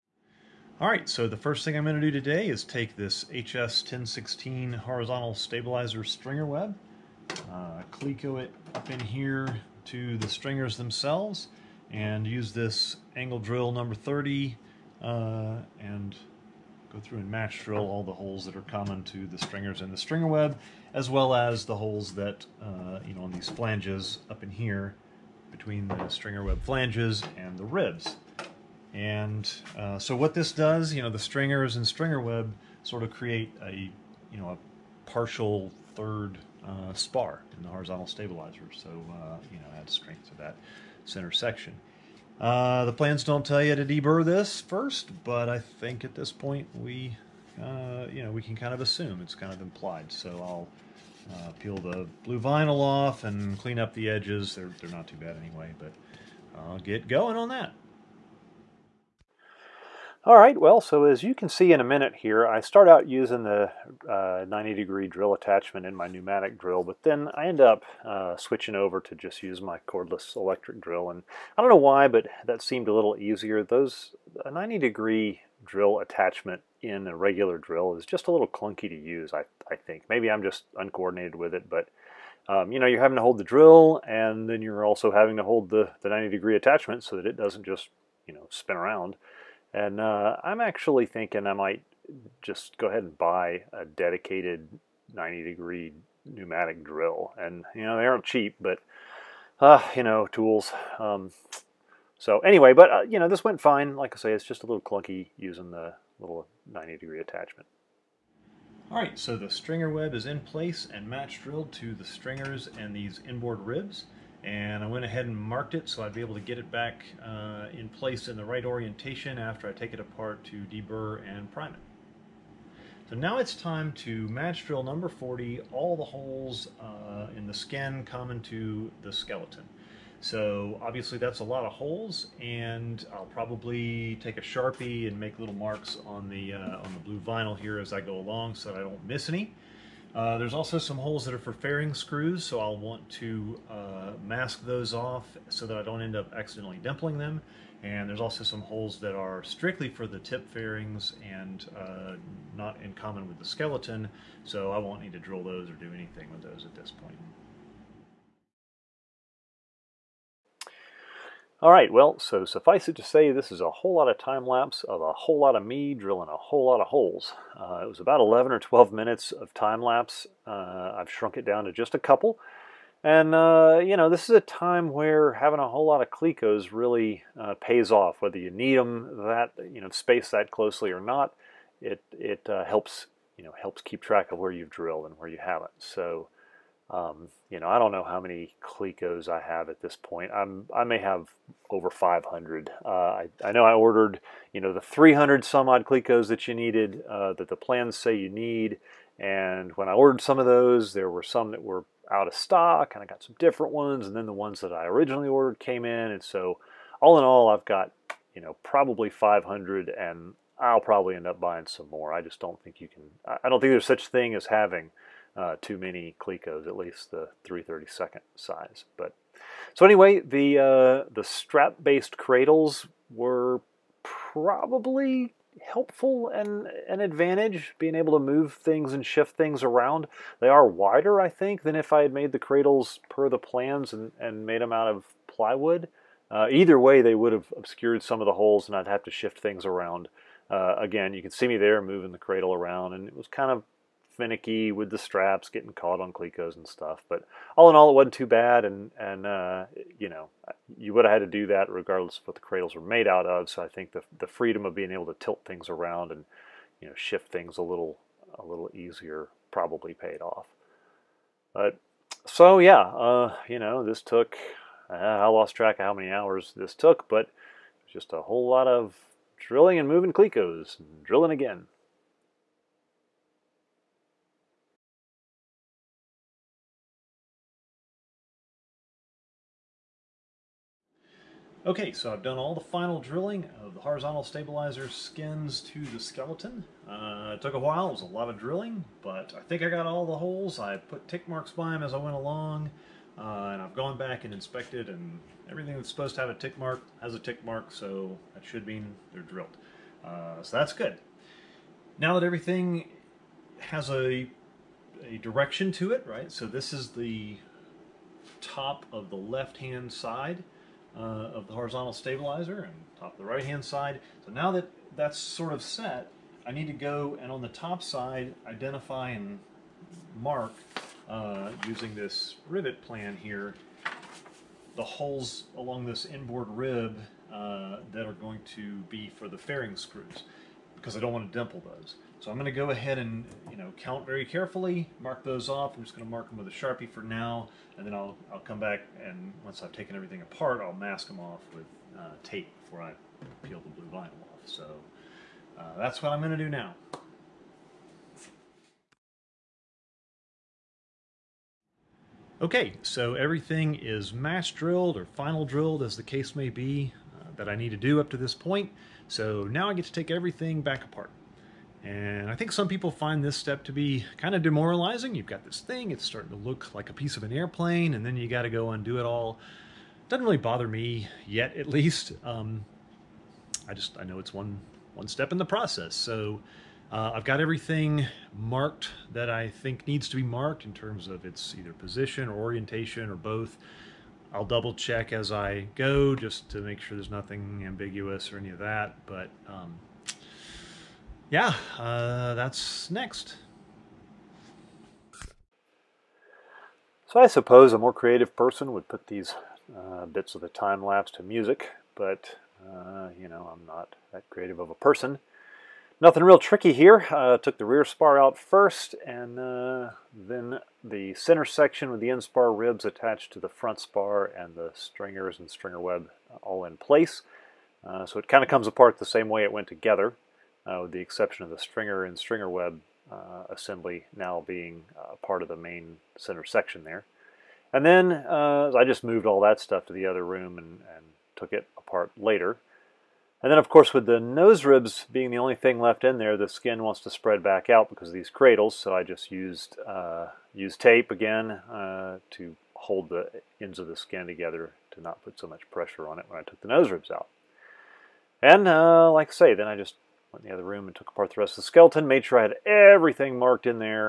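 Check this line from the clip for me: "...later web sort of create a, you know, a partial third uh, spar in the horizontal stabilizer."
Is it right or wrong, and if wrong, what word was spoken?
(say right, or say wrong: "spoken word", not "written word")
wrong: "stringer", not "later".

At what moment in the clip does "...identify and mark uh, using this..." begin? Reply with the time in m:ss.
5:18.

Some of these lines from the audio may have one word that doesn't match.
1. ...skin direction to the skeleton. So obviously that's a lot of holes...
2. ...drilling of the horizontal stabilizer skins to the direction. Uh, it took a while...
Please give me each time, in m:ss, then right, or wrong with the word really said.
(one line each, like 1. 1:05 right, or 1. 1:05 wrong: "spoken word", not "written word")
1. 2:07 wrong: "common", not "direction"
2. 4:42 wrong: "skeleton", not "direction".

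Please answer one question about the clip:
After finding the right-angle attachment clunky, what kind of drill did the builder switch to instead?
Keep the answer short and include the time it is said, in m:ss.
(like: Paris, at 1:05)
cordless electric drill, at 1:09.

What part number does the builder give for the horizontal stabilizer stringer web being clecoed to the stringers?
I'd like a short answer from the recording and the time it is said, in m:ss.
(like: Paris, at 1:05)
HS1016, at 0:03.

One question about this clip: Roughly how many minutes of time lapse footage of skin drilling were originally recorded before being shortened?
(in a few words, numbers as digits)
11 or 12.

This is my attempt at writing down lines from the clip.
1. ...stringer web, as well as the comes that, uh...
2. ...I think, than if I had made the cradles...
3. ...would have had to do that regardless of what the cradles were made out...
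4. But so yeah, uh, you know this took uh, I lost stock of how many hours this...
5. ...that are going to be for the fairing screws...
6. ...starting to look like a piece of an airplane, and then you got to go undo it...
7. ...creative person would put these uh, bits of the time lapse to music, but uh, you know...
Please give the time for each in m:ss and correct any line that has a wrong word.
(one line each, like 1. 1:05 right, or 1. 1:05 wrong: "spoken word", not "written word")
1. 0:19 wrong: "holes", not "comes"
2. 3:51 right
3. 4:10 right
4. 4:21 wrong: "track", not "stock"
5. 5:27 right
6. 6:06 right
7. 6:37 right.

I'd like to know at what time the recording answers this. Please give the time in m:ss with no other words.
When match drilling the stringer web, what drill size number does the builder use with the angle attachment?
0:13.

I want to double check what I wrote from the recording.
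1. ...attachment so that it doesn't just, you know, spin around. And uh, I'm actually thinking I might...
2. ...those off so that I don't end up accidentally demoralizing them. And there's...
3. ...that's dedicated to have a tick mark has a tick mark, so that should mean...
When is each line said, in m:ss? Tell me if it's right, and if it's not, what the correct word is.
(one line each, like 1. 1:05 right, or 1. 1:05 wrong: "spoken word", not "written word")
1. 1:26 right
2. 2:24 wrong: "dimpling", not "demoralizing"
3. 4:55 wrong: "supposed", not "dedicated".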